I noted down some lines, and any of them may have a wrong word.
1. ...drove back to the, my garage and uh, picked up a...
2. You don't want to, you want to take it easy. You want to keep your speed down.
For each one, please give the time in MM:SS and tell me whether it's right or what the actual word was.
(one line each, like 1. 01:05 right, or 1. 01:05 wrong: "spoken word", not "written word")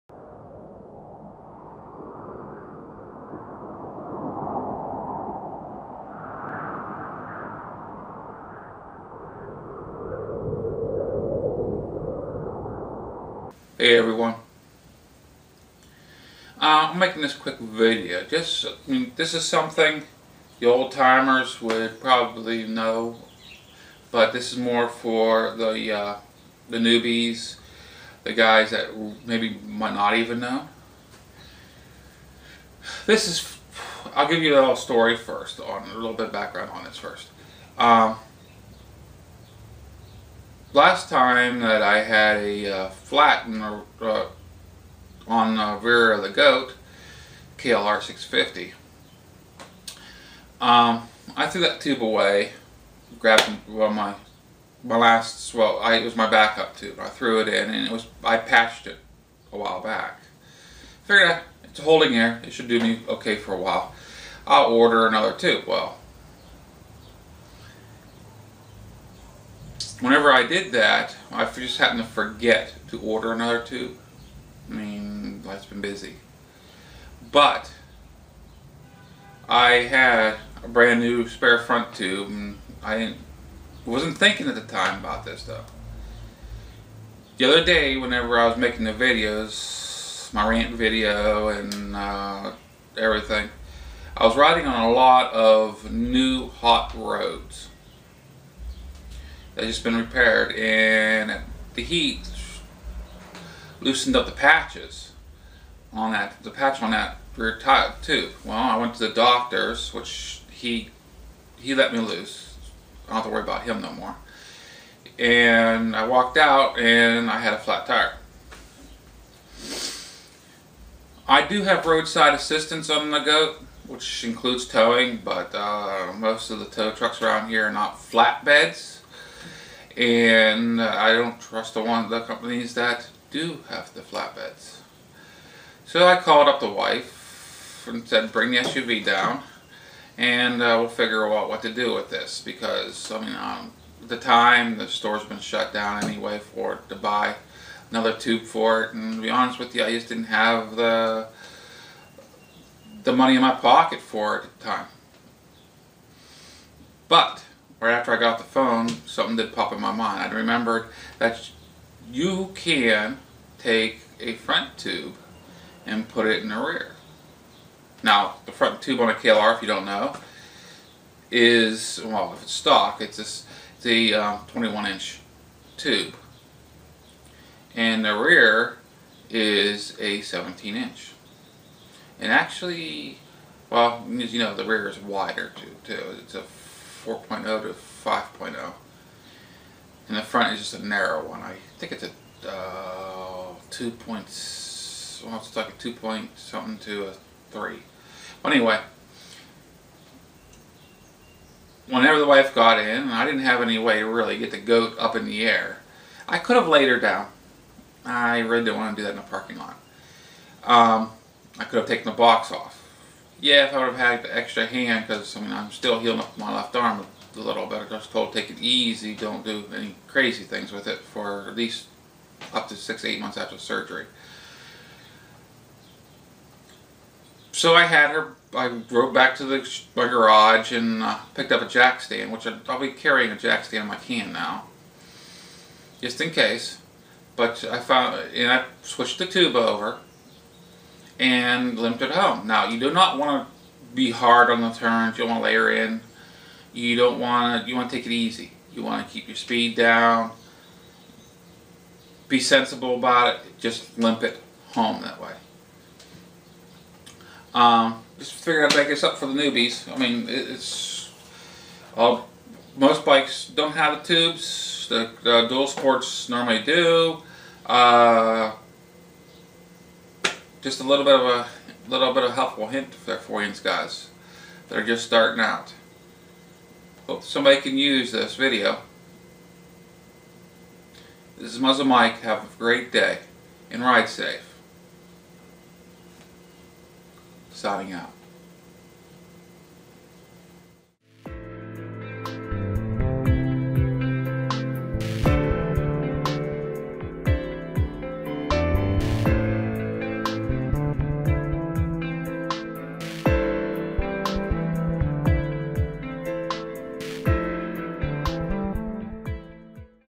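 1. 03:48 right
2. 04:06 right.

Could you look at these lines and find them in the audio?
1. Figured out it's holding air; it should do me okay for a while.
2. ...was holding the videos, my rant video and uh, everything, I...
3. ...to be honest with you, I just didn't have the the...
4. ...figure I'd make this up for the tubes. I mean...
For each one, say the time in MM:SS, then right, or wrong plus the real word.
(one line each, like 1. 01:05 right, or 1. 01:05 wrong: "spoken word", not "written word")
1. 01:01 right
2. 01:28 wrong: "making", not "holding"
3. 02:29 right
4. 04:18 wrong: "newbies", not "tubes".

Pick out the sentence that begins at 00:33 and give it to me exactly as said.
This is, I'll give you a little story first on a little bit of background on this first.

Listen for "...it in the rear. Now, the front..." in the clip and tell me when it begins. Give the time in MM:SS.
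02:46.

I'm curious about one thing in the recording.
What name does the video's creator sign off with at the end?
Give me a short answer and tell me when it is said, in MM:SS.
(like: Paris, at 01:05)
Muzzle Mike, at 04:41.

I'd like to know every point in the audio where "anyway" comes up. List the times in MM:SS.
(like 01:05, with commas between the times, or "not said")
02:26, 03:18.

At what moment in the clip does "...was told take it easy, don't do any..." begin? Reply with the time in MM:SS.
03:37.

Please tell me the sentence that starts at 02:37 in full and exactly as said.
But right after I got the phone, something did pop in my mind.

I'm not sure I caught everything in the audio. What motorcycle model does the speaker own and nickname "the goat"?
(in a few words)
KLR 650.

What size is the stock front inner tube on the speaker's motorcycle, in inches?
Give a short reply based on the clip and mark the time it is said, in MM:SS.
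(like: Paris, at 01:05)
21 inch, at 02:54.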